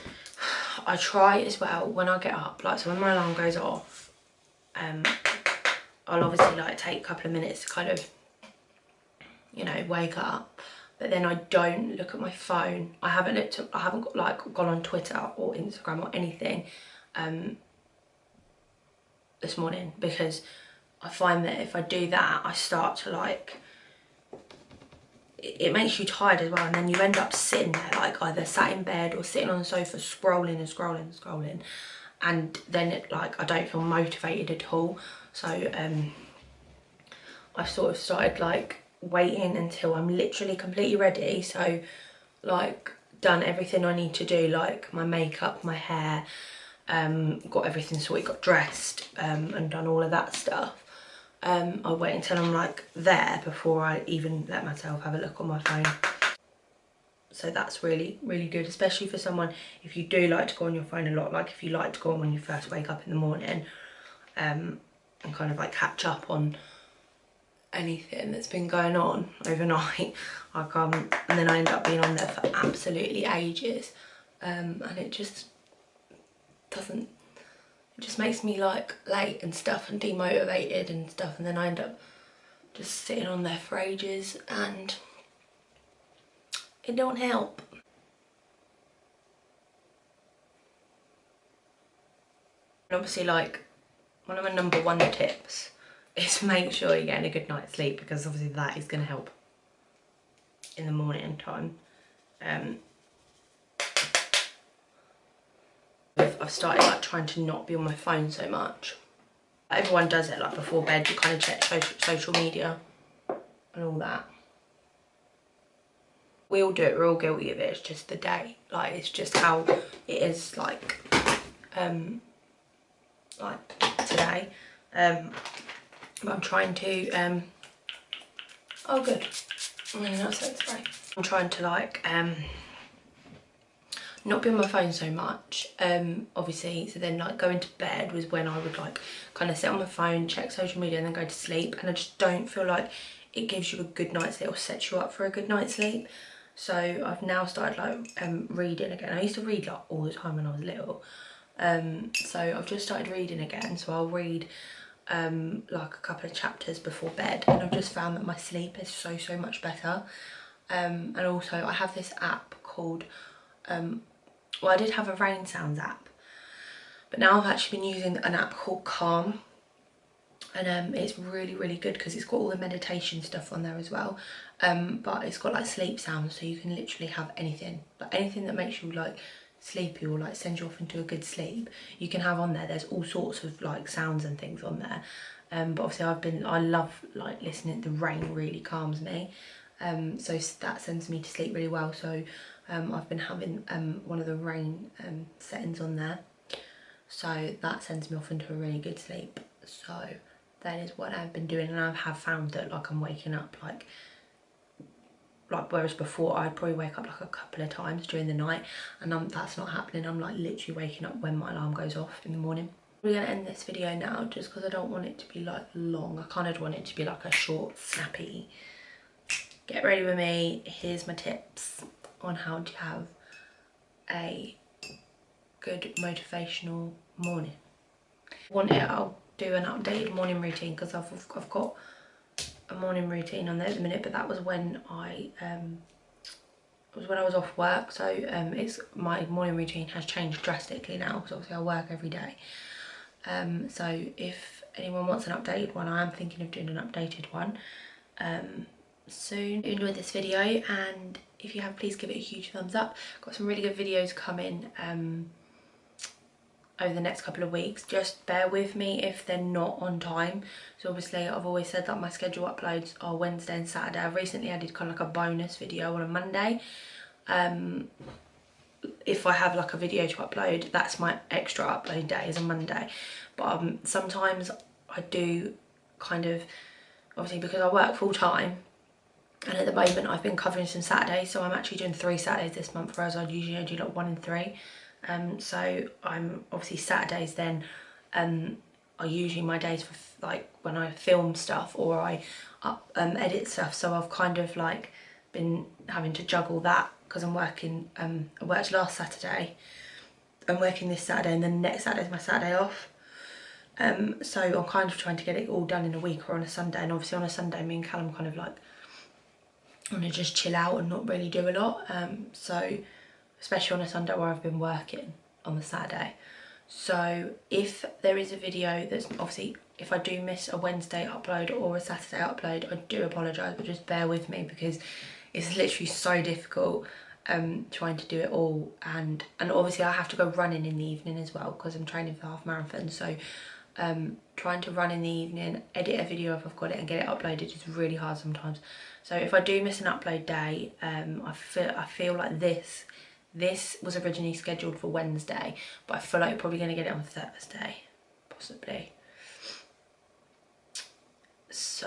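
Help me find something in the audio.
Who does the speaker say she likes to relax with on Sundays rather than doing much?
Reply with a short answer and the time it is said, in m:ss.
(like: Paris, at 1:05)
Callum, at 5:07.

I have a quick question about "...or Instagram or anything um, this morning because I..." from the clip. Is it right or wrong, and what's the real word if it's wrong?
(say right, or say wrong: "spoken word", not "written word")
right.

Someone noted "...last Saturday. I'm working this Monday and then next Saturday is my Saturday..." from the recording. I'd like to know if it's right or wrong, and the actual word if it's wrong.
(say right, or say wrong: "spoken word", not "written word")
wrong: "Saturday", not "Monday".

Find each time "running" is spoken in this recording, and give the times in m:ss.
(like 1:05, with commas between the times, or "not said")
5:30.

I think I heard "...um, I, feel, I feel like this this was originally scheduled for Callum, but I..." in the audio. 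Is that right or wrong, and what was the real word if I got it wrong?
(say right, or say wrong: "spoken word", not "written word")
wrong: "Wednesday", not "Callum".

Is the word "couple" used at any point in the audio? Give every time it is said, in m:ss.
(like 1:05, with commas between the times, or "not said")
0:07, 2:35, 3:27, 4:17.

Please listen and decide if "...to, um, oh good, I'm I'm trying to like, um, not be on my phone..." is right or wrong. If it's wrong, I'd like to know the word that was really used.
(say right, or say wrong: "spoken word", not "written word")
right.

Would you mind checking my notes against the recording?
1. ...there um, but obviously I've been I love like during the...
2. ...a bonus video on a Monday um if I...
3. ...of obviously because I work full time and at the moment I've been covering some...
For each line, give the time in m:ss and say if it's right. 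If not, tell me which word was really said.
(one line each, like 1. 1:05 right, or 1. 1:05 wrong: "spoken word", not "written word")
1. 3:04 wrong: "listening", not "during"
2. 4:25 right
3. 4:36 right.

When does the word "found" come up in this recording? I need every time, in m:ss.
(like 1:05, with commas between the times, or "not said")
2:37, 3:22.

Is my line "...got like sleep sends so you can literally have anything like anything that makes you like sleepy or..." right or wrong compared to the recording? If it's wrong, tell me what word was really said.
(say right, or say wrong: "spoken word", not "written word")
wrong: "sounds", not "sends".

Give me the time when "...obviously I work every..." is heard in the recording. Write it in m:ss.
4:01.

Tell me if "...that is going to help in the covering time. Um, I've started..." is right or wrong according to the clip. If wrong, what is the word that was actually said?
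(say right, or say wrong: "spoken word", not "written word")
wrong: "morning", not "covering".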